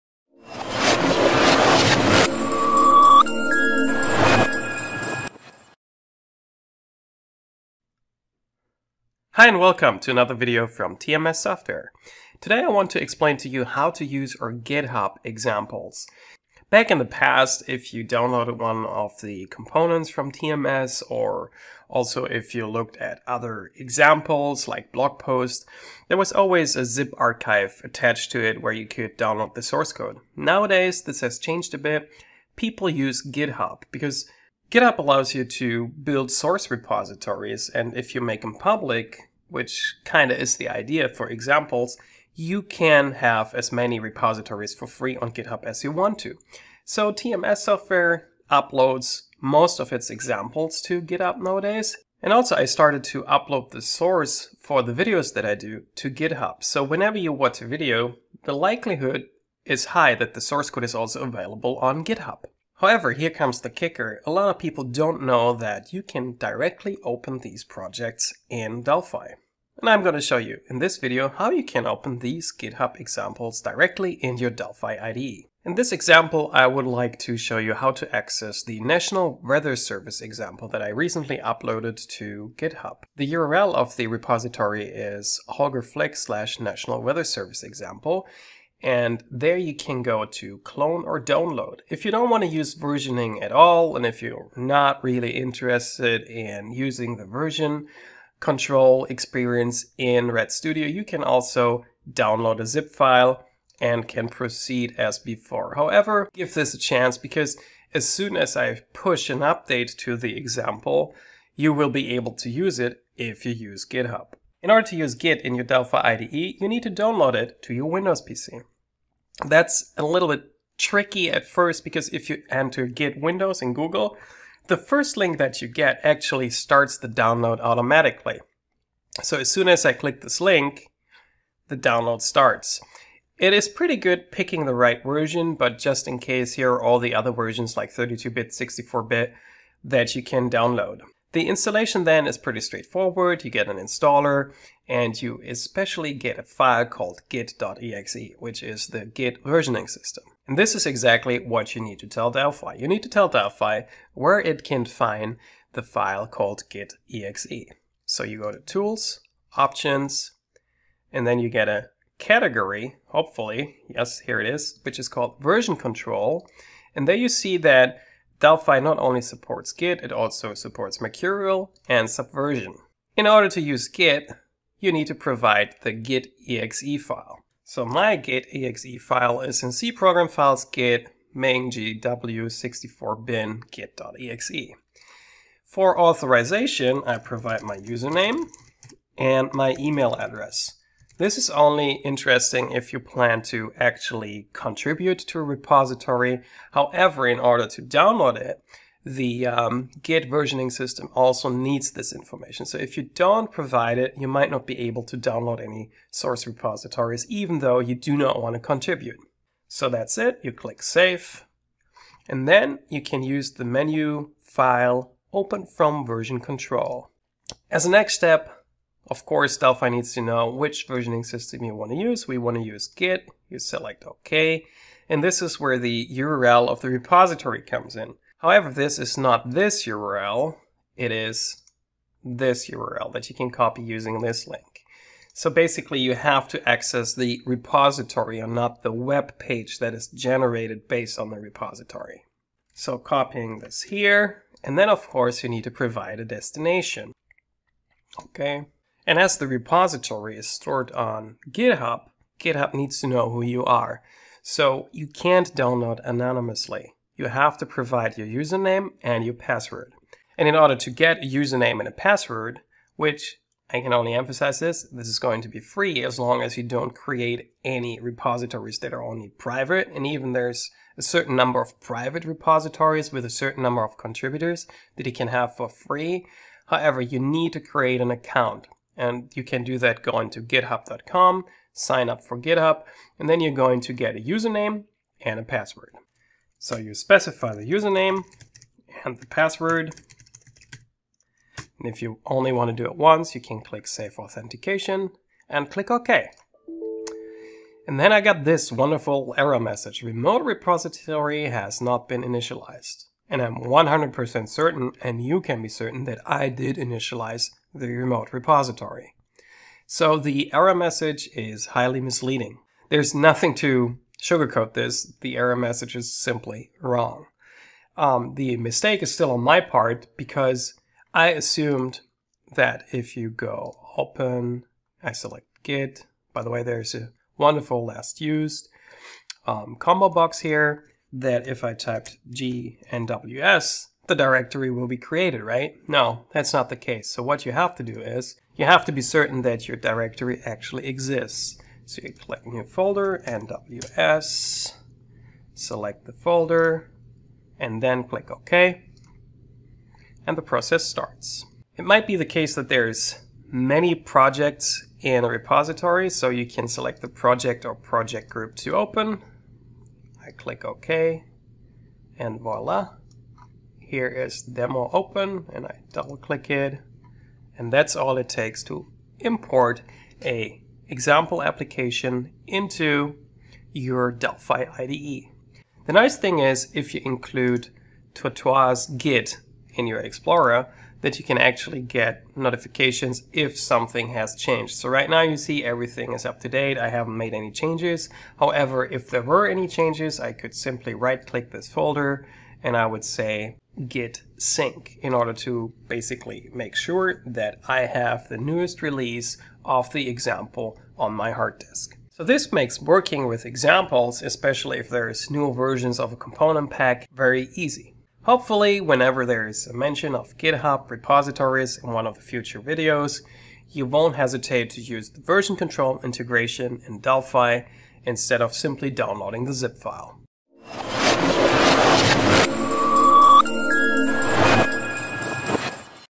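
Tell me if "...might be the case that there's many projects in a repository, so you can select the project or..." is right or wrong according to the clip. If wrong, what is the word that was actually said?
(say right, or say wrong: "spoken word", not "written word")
right.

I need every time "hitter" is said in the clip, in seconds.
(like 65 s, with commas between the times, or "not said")
not said.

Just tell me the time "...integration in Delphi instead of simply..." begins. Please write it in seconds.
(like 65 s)
416 s.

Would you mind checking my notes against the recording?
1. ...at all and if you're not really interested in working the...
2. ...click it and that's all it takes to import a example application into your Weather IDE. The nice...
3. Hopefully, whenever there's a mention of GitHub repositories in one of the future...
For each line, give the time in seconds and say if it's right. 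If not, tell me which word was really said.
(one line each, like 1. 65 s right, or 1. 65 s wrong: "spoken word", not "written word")
1. 93 s wrong: "using", not "working"
2. 366 s wrong: "Delphi", not "Weather"
3. 408 s right.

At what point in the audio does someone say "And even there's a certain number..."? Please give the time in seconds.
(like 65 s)
269 s.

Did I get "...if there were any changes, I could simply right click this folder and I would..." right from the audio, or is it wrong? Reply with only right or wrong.
right.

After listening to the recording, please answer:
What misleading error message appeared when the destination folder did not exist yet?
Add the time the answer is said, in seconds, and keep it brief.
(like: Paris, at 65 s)
Remote repository has not been initialized, at 300 s.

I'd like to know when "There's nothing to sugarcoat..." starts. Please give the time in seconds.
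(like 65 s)
312 s.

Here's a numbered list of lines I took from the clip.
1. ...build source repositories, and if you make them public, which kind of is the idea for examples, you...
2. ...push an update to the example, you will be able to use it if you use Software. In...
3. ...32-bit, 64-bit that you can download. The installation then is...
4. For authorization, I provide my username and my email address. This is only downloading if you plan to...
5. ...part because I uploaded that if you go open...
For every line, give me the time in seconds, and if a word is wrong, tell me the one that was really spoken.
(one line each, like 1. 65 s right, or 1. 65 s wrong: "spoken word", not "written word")
1. 36 s right
2. 108 s wrong: "GitHub", not "Software"
3. 137 s right
4. 185 s wrong: "interesting", not "downloading"
5. 319 s wrong: "assumed", not "uploaded".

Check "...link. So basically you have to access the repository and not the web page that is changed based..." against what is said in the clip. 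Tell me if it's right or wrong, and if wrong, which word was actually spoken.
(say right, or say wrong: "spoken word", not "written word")
wrong: "generated", not "changed".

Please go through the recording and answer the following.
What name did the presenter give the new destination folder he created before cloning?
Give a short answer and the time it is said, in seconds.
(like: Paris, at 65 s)
NWS, at 343 s.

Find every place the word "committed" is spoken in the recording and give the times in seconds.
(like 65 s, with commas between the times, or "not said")
not said.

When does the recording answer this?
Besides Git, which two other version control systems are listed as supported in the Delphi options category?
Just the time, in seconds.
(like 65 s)
170 s.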